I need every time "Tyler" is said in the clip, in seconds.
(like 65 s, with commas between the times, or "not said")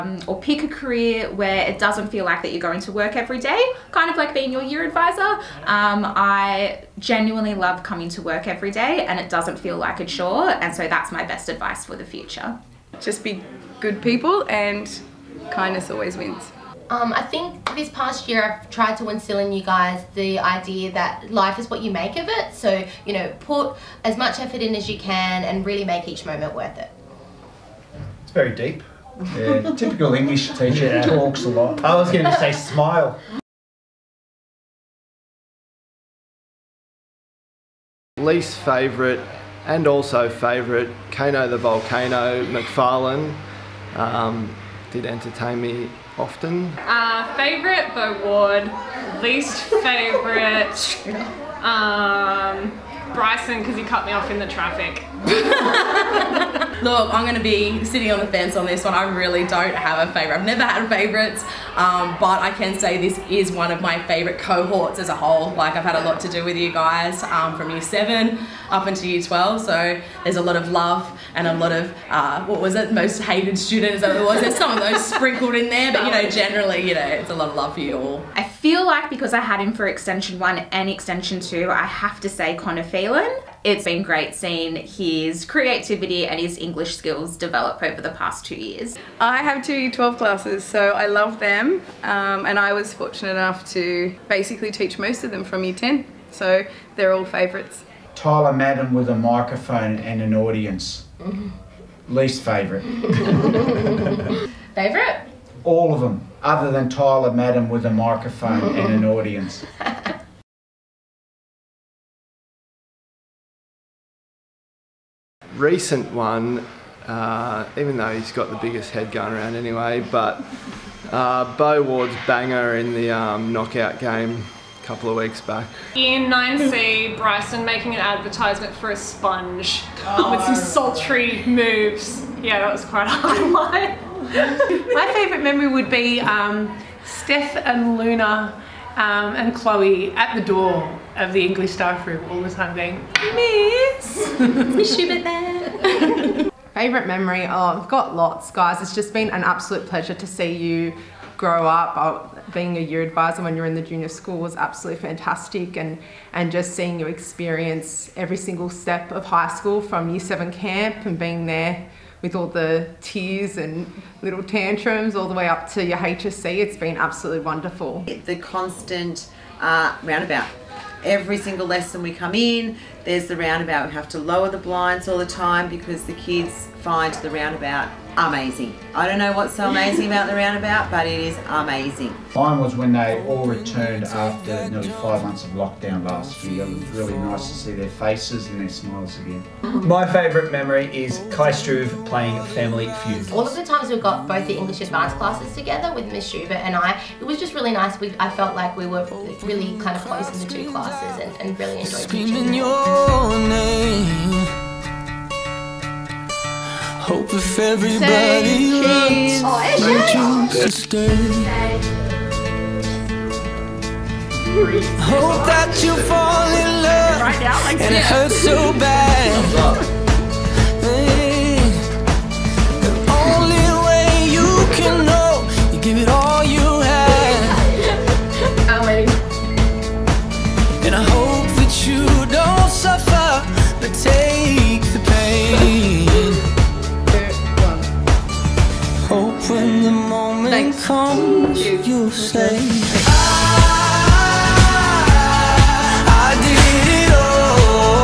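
98 s, 106 s.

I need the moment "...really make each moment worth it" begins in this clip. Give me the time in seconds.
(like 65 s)
25 s.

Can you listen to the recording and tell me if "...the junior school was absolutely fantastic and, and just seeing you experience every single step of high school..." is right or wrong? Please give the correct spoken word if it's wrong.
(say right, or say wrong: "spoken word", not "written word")
right.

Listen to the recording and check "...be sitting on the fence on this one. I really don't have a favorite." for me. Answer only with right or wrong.
right.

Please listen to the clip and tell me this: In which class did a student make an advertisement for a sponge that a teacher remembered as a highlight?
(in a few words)
9C.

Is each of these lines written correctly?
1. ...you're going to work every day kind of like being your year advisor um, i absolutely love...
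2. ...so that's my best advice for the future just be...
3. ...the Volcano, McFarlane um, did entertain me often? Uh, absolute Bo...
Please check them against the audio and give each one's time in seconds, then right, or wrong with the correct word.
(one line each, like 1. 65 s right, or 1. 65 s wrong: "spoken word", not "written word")
1. 2 s wrong: "genuinely", not "absolutely"
2. 10 s right
3. 41 s wrong: "favorite", not "absolute".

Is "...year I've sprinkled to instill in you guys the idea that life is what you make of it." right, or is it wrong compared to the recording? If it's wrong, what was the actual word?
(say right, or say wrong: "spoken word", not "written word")
wrong: "tried", not "sprinkled".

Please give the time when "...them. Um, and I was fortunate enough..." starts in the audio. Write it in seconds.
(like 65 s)
91 s.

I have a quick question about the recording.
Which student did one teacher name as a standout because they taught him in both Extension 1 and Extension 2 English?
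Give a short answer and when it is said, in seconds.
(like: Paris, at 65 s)
Connor Phelan, at 82 s.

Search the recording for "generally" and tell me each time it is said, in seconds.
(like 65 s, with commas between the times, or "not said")
76 s.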